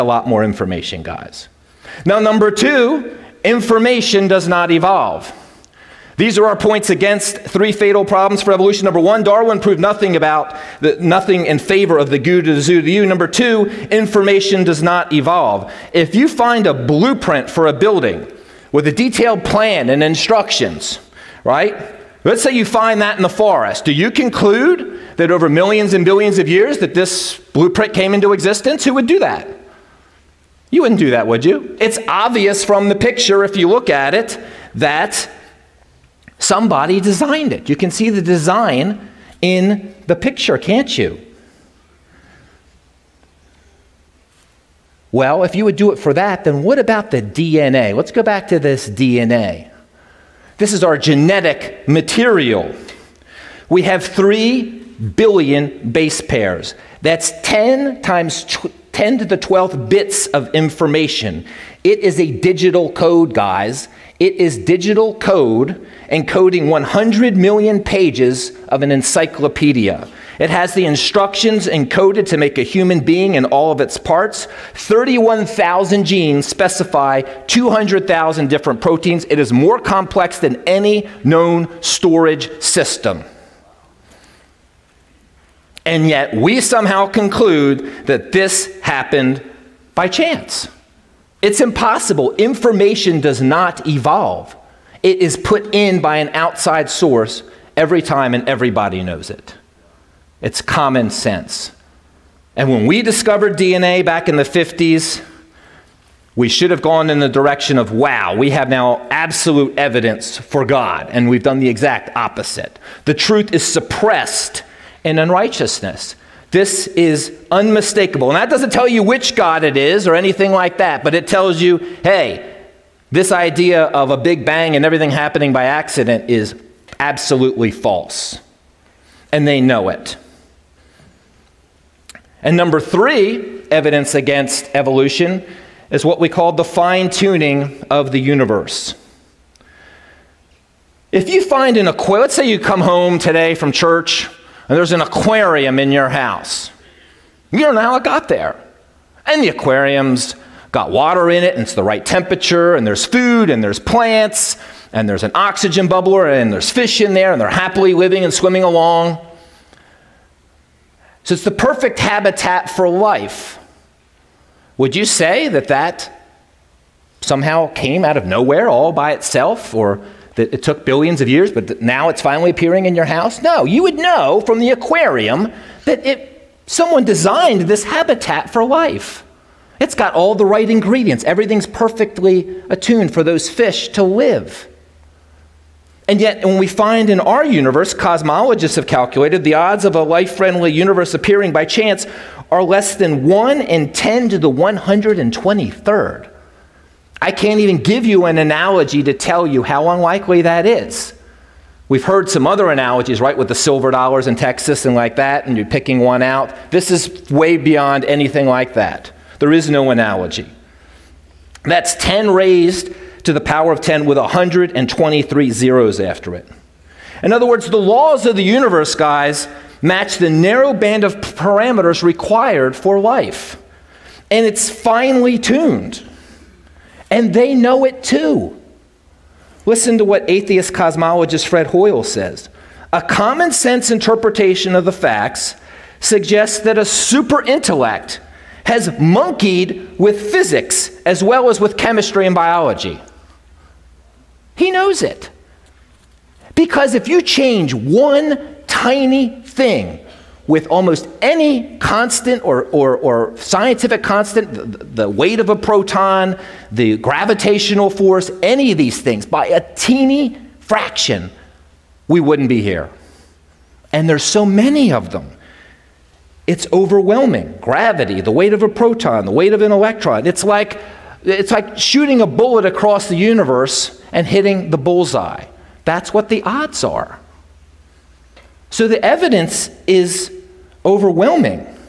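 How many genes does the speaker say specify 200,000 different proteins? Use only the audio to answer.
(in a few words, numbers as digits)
31,000.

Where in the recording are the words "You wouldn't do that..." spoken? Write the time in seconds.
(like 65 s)
30 s.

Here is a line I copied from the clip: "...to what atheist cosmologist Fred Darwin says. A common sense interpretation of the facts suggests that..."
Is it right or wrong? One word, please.
wrong.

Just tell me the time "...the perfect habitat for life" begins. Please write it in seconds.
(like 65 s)
161 s.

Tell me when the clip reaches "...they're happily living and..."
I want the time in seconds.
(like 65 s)
157 s.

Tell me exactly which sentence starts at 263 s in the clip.
And there's so many of them.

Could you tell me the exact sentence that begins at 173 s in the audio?
No, you would know from the aquarium that it, someone designed this habitat for life.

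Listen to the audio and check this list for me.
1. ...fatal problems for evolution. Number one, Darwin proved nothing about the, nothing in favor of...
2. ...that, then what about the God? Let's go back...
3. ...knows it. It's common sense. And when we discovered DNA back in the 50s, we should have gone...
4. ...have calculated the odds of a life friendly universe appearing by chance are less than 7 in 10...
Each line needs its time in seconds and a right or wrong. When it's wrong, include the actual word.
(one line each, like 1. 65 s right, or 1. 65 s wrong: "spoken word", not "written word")
1. 7 s right
2. 46 s wrong: "DNA", not "God"
3. 99 s right
4. 188 s wrong: "1", not "7".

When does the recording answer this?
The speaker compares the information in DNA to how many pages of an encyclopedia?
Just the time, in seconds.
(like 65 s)
66 s.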